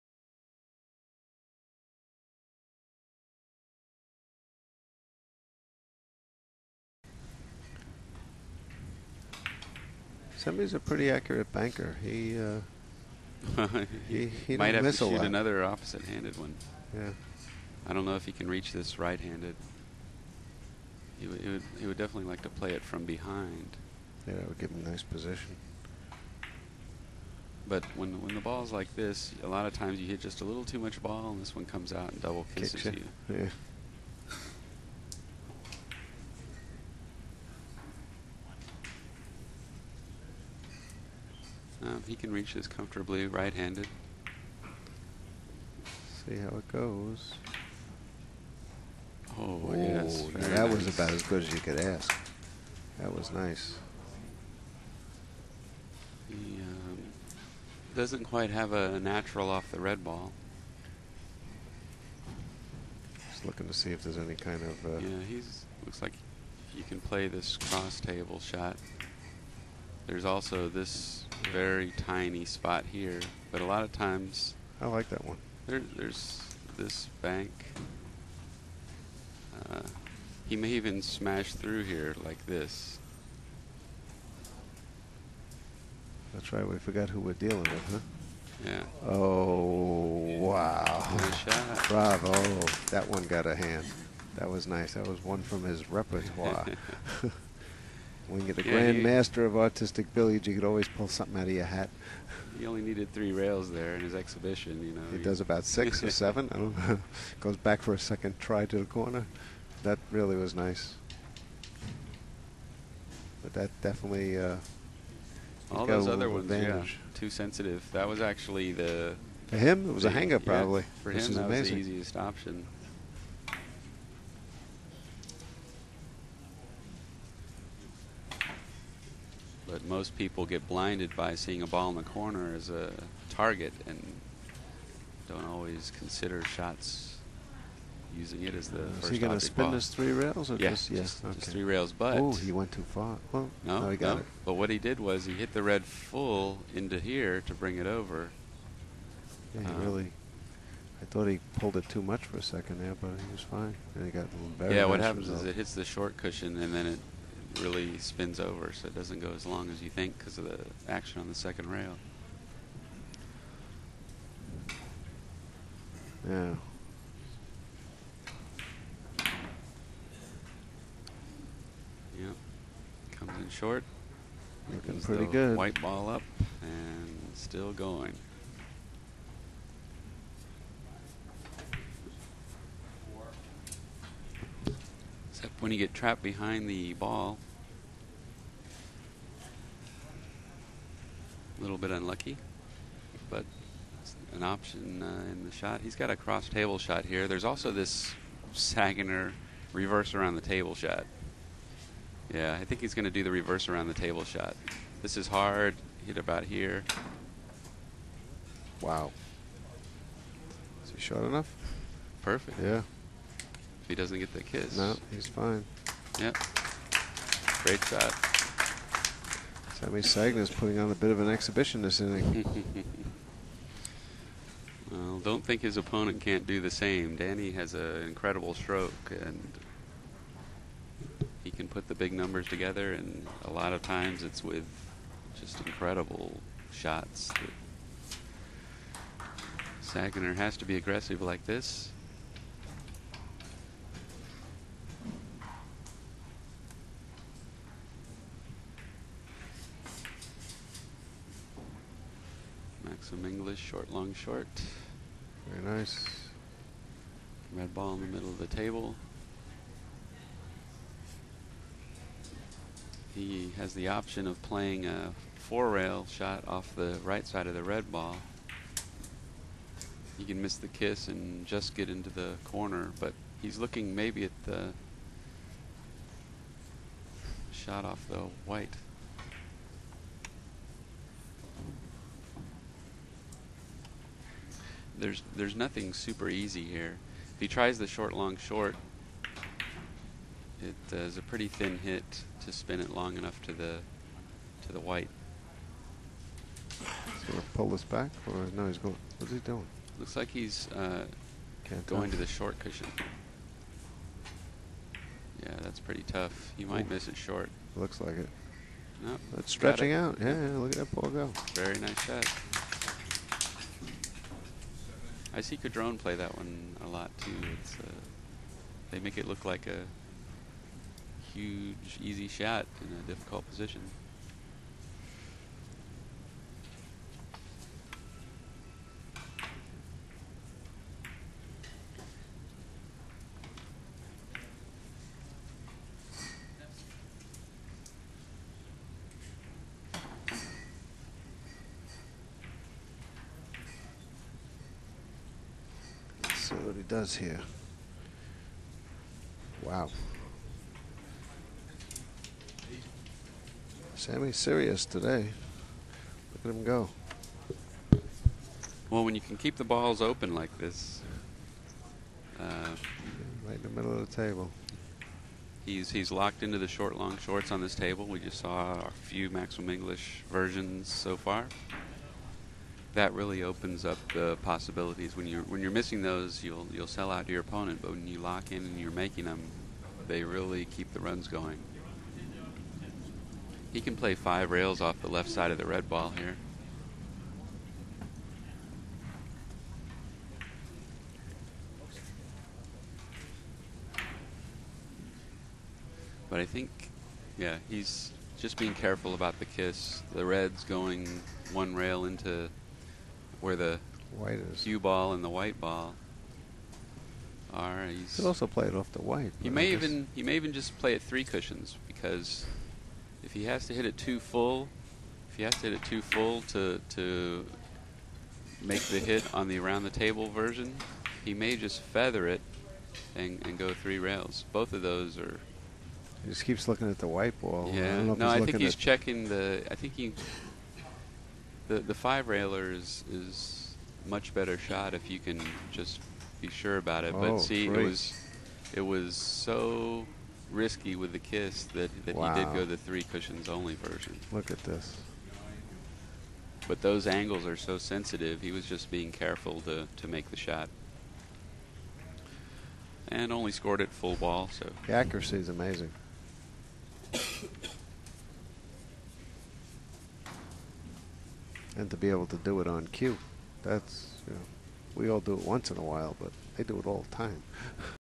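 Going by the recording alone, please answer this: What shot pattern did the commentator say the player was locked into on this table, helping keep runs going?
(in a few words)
Short, long, shorts.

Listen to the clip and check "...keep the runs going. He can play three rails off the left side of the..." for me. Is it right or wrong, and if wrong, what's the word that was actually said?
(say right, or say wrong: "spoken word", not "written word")
wrong: "five", not "three".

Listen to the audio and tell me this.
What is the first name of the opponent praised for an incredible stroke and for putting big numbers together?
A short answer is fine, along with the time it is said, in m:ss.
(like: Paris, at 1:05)
Danny, at 3:47.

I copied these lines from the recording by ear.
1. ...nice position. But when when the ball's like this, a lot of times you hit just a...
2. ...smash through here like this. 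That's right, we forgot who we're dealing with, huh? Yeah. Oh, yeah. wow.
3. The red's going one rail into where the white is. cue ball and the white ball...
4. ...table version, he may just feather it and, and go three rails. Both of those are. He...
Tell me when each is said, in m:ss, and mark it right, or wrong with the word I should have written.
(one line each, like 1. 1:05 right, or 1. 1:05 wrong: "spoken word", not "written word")
1. 0:24 right
2. 1:21 right
3. 6:40 right
4. 6:59 right.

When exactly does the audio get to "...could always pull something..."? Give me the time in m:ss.
1:40.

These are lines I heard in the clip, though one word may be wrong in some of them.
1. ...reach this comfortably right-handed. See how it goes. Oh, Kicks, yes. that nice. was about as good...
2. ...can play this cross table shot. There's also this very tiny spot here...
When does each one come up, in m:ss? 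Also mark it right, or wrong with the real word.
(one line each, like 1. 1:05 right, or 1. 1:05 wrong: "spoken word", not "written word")
1. 0:42 wrong: "Ooh", not "Kicks"
2. 1:06 right.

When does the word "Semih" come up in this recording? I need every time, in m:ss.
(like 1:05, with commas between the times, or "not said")
3:39, 5:53.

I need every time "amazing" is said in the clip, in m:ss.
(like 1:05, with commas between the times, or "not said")
2:01, 7:35.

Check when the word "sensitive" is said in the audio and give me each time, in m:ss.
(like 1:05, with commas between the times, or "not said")
1:57, 7:27.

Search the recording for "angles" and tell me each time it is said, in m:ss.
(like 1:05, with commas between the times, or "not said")
7:27.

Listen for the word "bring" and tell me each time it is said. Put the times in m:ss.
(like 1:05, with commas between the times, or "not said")
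2:27.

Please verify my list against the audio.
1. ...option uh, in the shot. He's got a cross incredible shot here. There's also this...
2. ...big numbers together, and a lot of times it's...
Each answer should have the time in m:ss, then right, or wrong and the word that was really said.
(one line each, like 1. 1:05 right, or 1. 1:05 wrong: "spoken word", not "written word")
1. 3:14 wrong: "table", not "incredible"
2. 3:51 right.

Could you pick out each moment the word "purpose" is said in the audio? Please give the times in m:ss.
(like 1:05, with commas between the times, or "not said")
not said.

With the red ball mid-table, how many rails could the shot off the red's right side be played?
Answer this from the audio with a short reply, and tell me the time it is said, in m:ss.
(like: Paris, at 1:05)
4, at 4:25.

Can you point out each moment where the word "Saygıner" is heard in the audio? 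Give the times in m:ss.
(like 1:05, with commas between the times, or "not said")
3:18, 3:40, 3:59.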